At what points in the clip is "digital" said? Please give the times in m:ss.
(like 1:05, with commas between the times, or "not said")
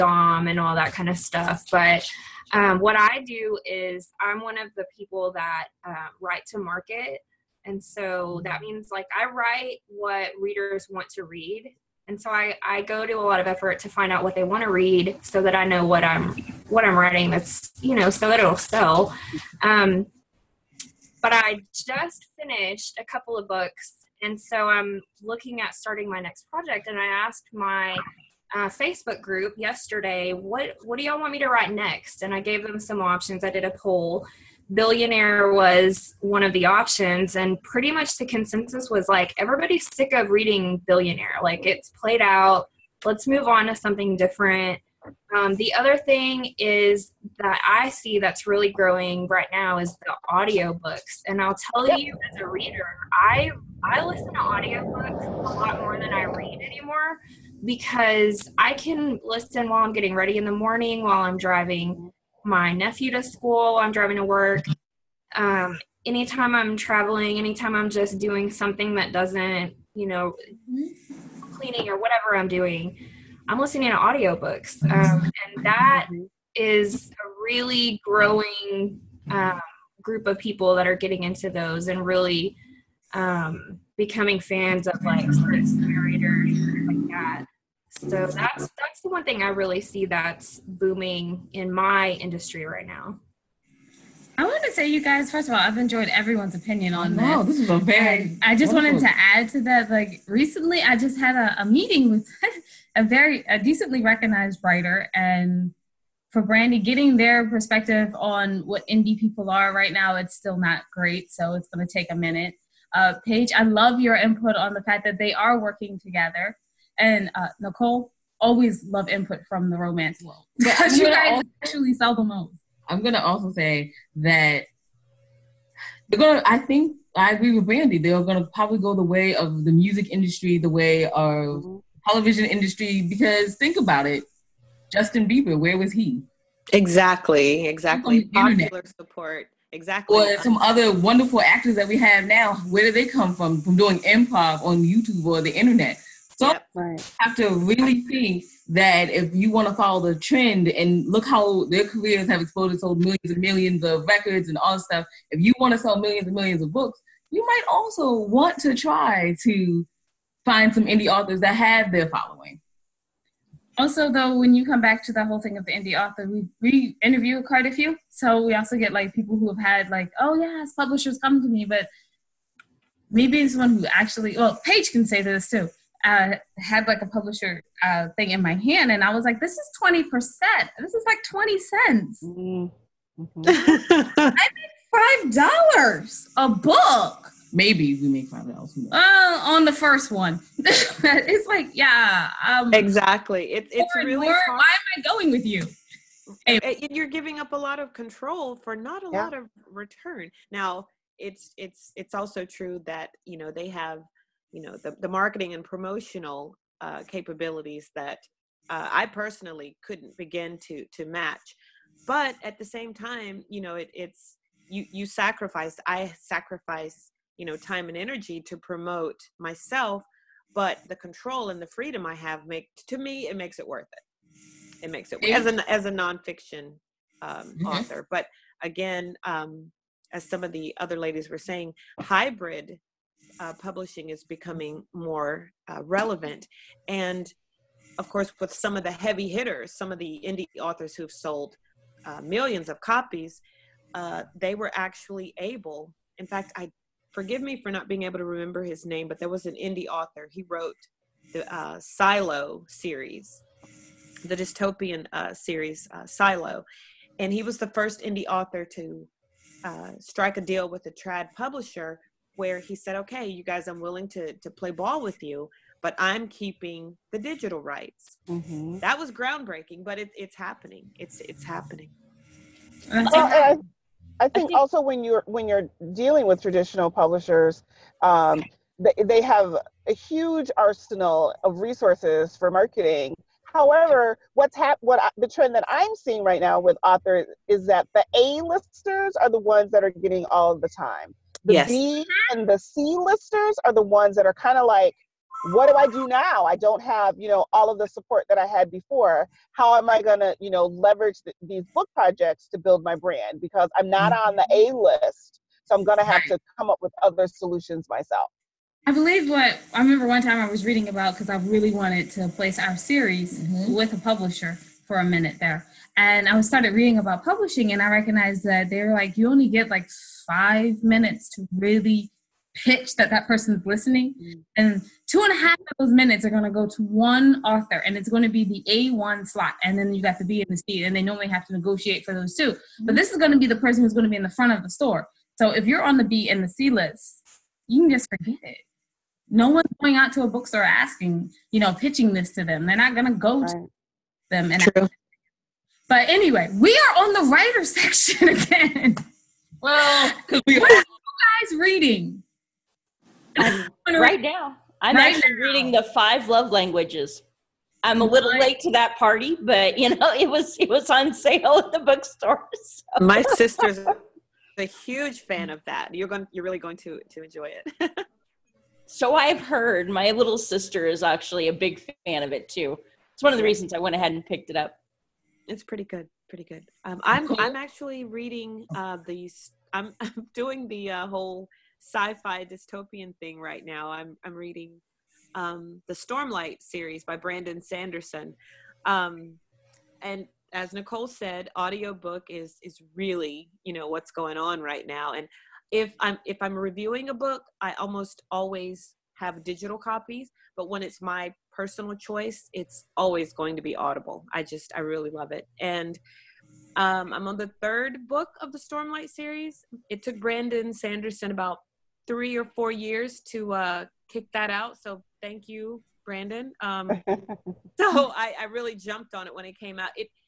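4:27, 6:39.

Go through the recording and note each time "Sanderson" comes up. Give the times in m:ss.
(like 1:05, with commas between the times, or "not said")
6:27, 6:50.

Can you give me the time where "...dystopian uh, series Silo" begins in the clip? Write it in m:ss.
4:14.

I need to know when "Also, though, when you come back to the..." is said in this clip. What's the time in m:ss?
2:43.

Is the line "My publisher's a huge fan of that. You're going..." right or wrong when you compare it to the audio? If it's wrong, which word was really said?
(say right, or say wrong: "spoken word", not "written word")
wrong: "sister", not "publisher".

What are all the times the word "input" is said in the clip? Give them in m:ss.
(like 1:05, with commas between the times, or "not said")
1:54, 1:59.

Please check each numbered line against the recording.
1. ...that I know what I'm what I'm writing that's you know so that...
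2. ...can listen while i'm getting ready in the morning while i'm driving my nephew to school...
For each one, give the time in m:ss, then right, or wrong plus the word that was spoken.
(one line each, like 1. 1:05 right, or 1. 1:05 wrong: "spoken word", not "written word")
1. 0:15 right
2. 0:58 right.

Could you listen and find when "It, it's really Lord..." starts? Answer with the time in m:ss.
3:13.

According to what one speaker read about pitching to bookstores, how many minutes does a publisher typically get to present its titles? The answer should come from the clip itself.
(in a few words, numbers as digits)
5 minutes.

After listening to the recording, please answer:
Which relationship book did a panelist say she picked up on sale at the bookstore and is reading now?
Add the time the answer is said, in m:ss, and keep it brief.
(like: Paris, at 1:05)
The Five Love Languages, at 5:55.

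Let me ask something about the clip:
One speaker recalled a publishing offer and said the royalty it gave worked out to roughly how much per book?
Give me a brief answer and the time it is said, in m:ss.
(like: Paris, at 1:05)
20 cents, at 3:01.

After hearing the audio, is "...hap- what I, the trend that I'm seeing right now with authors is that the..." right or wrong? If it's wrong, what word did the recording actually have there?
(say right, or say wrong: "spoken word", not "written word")
right.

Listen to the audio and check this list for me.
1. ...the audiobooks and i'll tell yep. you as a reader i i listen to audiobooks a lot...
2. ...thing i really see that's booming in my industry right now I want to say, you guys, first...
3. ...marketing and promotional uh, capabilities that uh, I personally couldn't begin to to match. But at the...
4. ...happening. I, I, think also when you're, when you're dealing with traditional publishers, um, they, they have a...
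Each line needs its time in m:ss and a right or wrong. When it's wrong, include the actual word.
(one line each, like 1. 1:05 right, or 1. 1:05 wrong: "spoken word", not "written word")
1. 0:50 right
2. 1:29 right
3. 3:25 right
4. 4:31 right.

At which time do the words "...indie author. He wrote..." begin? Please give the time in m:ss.
4:09.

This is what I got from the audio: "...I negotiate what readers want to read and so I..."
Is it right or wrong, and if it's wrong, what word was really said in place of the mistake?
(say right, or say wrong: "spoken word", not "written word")
wrong: "write", not "negotiate".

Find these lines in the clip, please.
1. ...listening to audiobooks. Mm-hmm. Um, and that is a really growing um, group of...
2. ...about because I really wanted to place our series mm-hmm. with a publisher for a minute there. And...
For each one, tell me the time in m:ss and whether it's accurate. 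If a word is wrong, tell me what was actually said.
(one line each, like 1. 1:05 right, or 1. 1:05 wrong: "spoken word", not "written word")
1. 1:13 right
2. 5:10 right.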